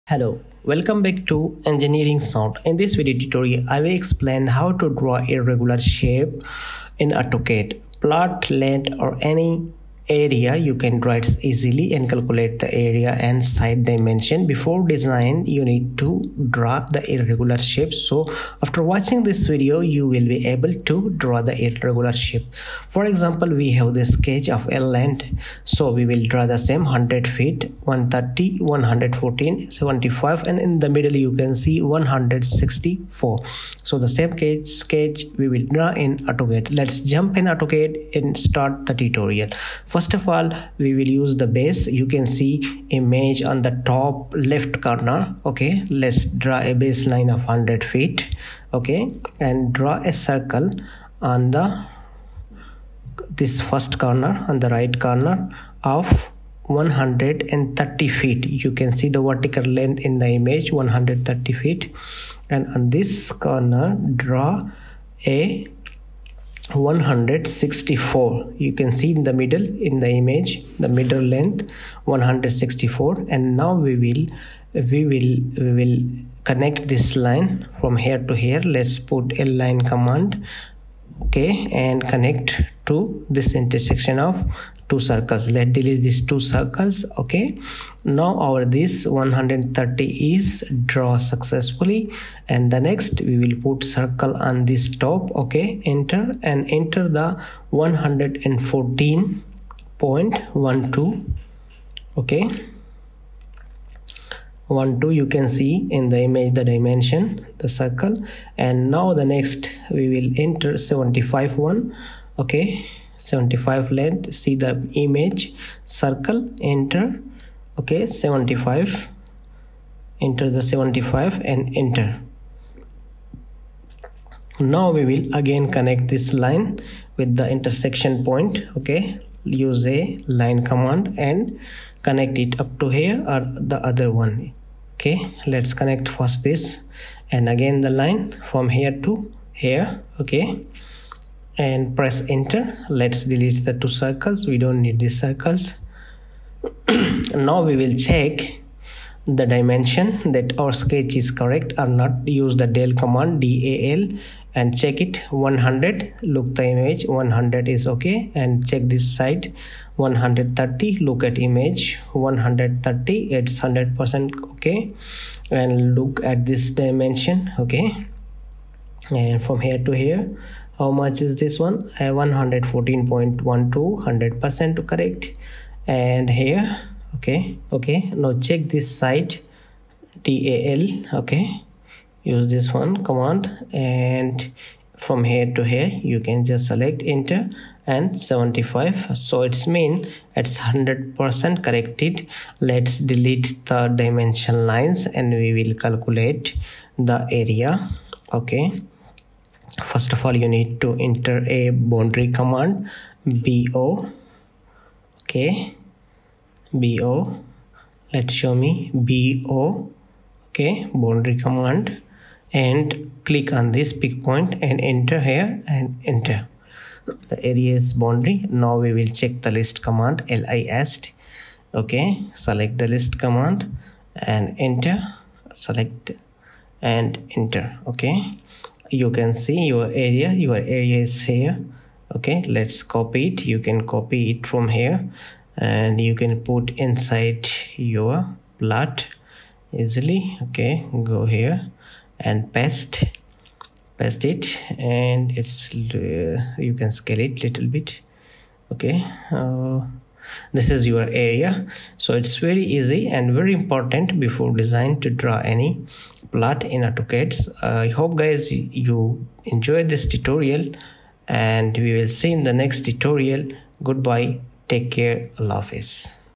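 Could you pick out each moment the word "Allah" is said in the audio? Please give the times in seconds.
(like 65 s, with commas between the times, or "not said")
265 s.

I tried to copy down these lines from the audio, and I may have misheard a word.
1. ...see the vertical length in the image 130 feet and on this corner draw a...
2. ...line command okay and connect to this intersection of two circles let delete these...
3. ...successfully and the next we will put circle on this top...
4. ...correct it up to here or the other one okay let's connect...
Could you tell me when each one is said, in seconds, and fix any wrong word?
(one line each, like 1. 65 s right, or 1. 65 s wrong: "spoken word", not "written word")
1. 58 s right
2. 79 s right
3. 91 s right
4. 132 s wrong: "connect", not "correct".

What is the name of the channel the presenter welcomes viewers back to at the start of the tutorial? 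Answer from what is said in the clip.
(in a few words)
Engineering Sound.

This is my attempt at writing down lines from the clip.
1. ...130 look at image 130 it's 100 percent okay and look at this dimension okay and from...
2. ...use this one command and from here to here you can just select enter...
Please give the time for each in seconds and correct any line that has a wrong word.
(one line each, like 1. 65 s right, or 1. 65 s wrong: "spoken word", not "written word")
1. 159 s right
2. 182 s right.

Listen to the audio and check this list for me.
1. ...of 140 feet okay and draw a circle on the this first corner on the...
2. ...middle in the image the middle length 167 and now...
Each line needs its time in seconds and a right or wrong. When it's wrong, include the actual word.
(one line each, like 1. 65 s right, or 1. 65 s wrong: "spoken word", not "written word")
1. 47 s wrong: "100", not "140"
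2. 69 s wrong: "164", not "167".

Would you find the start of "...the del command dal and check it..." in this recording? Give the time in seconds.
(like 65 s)
152 s.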